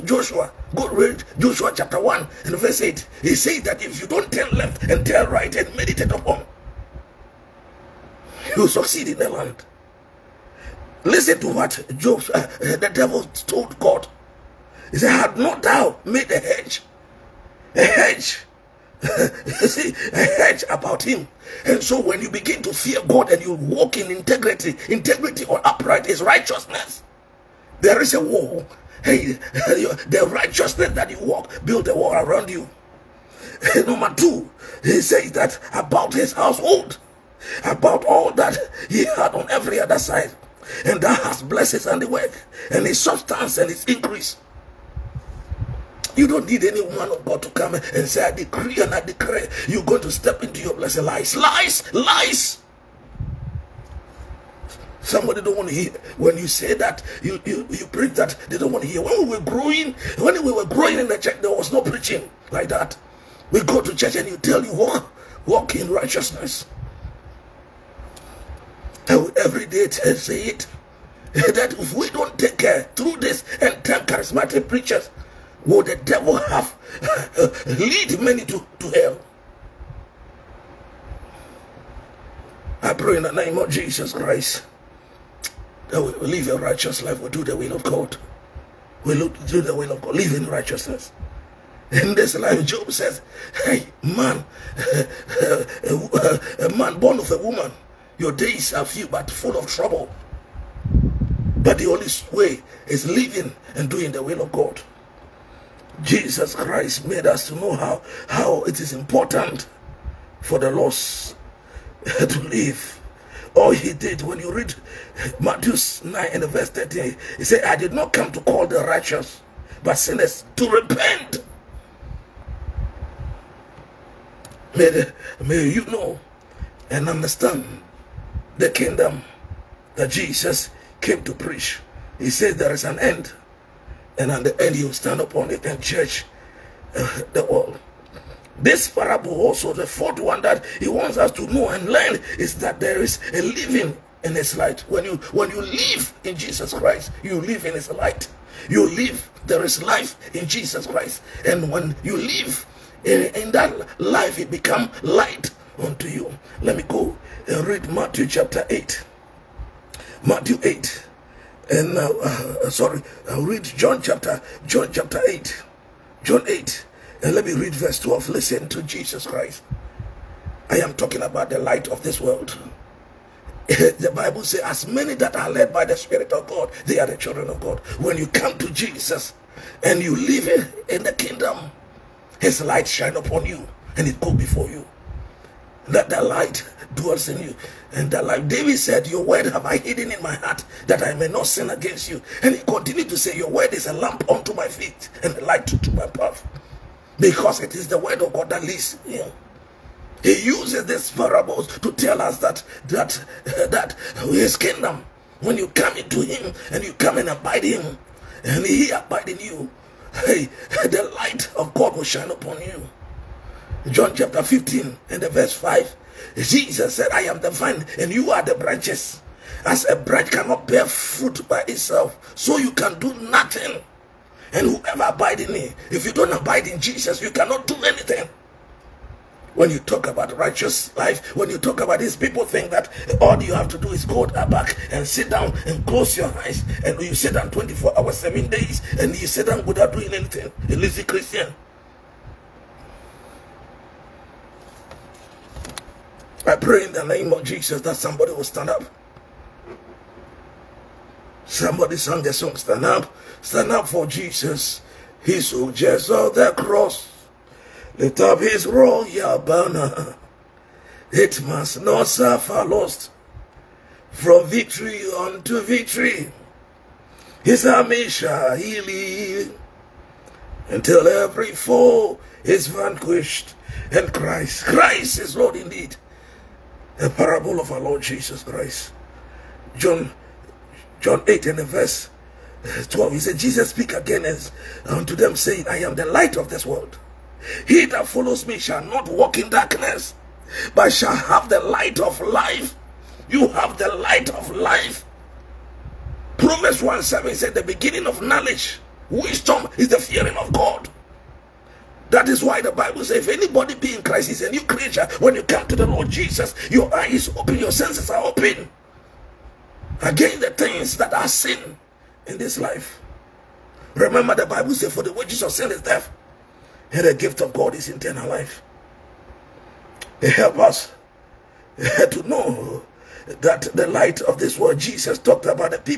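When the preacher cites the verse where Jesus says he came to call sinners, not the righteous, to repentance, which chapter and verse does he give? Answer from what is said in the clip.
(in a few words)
Matthew 9:13.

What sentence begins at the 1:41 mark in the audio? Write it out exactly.
But the only way is living and doing the will of God.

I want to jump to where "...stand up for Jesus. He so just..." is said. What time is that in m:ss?
4:13.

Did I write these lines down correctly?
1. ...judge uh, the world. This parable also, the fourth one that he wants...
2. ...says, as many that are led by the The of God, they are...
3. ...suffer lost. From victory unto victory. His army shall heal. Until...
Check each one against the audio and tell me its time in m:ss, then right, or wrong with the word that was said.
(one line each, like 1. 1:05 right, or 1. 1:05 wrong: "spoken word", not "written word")
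1. 2:15 right
2. 2:54 wrong: "Spirit", not "The"
3. 4:22 right.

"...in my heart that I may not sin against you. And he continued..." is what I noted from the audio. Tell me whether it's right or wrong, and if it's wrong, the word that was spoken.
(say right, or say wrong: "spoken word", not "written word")
right.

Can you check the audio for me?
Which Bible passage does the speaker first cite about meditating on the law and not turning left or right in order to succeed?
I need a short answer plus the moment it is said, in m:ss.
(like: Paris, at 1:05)
Joshua 1:8, at 0:01.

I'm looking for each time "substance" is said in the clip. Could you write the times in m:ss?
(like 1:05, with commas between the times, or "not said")
0:42.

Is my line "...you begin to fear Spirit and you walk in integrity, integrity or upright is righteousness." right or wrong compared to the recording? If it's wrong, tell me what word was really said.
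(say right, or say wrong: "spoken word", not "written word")
wrong: "God", not "Spirit".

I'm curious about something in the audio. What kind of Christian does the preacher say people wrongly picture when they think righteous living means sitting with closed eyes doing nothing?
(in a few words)
lazy Christian.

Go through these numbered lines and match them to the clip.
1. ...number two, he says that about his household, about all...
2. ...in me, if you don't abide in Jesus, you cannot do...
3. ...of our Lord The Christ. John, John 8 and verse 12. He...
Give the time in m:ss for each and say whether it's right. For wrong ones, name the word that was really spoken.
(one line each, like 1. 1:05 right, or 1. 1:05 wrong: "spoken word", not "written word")
1. 0:33 right
2. 3:45 right
3. 4:37 wrong: "Jesus", not "The".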